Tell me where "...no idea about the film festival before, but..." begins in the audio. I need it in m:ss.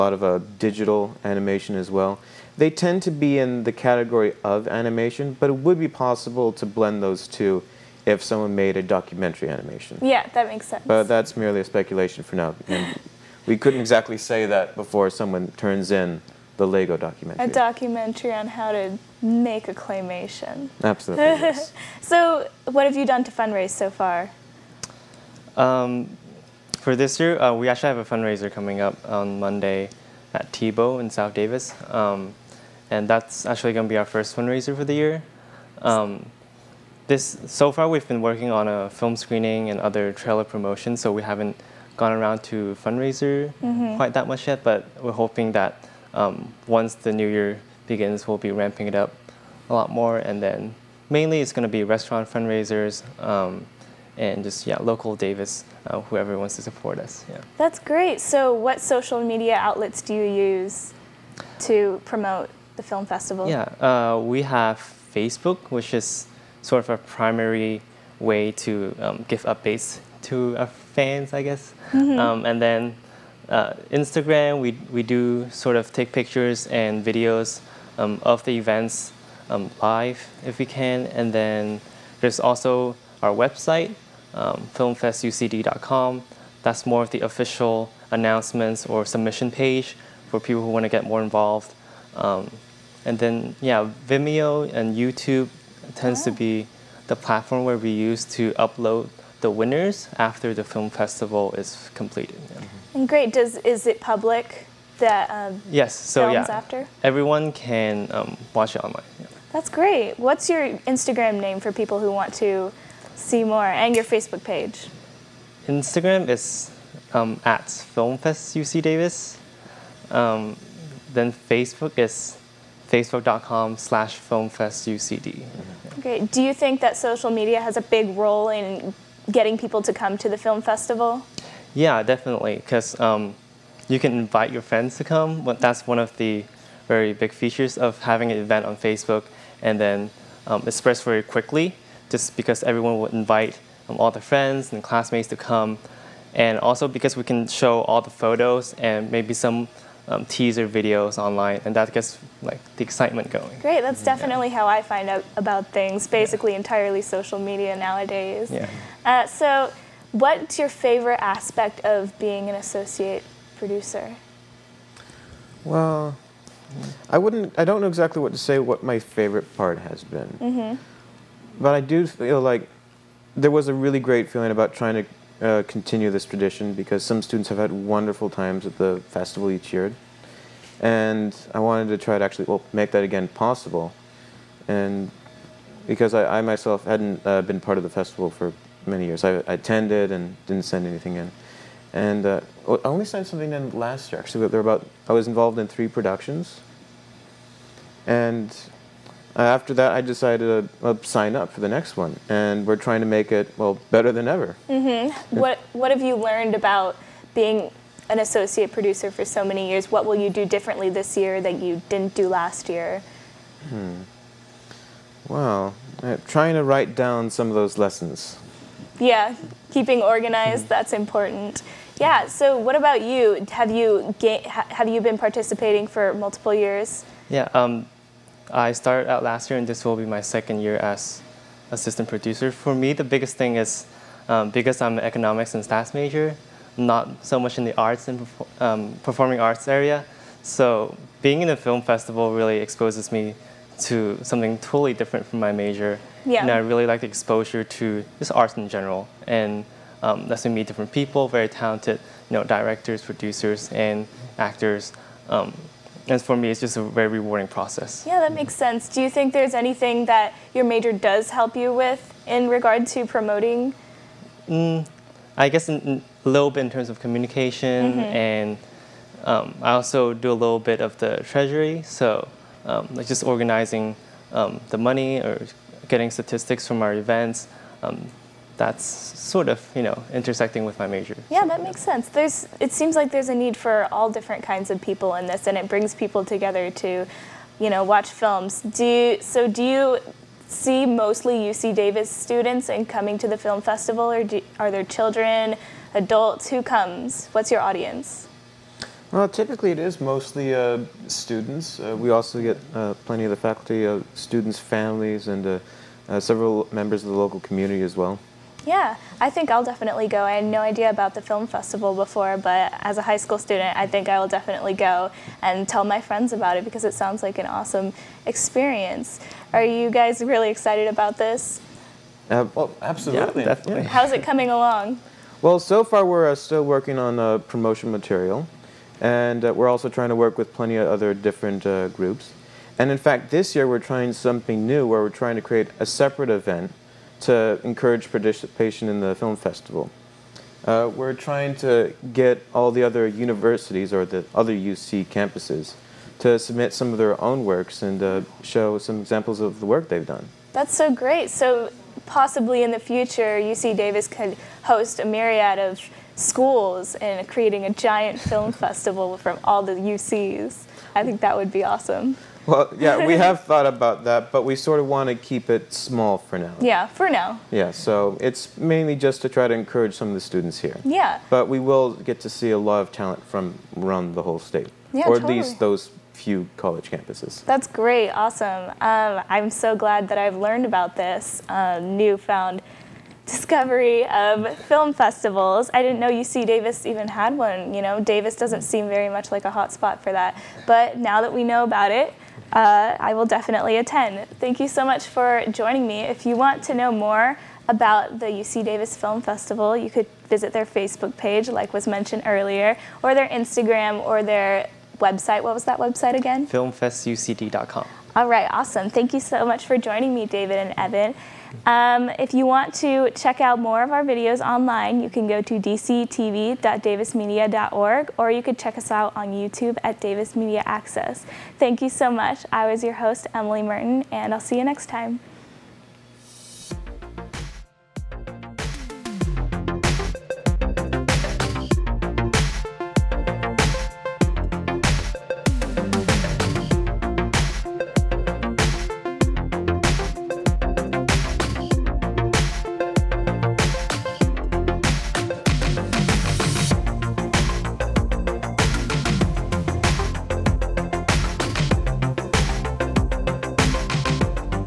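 5:10.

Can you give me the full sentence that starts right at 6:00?
I think that would be awesome.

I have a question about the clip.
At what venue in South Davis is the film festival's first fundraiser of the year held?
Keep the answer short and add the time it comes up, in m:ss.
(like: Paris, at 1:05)
Tebow, at 0:30.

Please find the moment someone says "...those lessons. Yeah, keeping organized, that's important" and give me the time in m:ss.
3:37.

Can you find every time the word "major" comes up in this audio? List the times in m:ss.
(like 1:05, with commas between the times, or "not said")
3:55, 4:05, 4:20, 4:40.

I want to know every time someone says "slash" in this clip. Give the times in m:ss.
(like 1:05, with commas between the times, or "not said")
2:03.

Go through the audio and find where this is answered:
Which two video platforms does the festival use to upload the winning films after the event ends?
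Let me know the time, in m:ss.
1:34.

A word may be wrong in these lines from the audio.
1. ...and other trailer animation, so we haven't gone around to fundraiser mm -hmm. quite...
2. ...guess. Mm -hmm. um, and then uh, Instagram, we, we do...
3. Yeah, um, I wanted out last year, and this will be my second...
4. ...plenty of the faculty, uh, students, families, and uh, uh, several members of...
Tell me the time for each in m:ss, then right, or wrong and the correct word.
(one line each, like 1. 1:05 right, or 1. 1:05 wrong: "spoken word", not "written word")
1. 0:39 wrong: "promotion", not "animation"
2. 1:11 right
3. 3:47 wrong: "started", not "wanted"
4. 5:03 right.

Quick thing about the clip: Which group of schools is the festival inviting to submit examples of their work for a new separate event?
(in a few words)
Other UC campuses.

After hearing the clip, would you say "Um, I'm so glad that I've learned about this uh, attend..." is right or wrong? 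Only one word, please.
wrong.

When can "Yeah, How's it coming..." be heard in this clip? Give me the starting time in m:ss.
5:23.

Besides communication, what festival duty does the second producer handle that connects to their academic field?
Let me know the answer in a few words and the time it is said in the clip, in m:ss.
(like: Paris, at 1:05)
Treasury, at 4:31.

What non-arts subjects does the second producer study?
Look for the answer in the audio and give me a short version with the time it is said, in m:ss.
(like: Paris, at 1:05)
Economics and stats, at 3:55.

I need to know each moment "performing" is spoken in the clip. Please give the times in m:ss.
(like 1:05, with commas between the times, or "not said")
3:59.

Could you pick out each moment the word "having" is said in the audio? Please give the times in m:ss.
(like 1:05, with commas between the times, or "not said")
2:18.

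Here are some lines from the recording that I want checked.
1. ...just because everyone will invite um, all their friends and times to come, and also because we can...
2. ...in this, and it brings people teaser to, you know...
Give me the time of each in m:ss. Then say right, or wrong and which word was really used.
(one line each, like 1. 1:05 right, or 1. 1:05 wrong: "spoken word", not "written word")
1. 2:22 wrong: "classmates", not "times"
2. 4:45 wrong: "together", not "teaser".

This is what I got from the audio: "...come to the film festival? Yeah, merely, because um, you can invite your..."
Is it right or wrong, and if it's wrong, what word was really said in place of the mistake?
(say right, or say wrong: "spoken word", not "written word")
wrong: "definitely", not "merely".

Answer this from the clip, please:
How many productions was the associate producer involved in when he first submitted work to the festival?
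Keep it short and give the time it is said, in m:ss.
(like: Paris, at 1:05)
3, at 3:15.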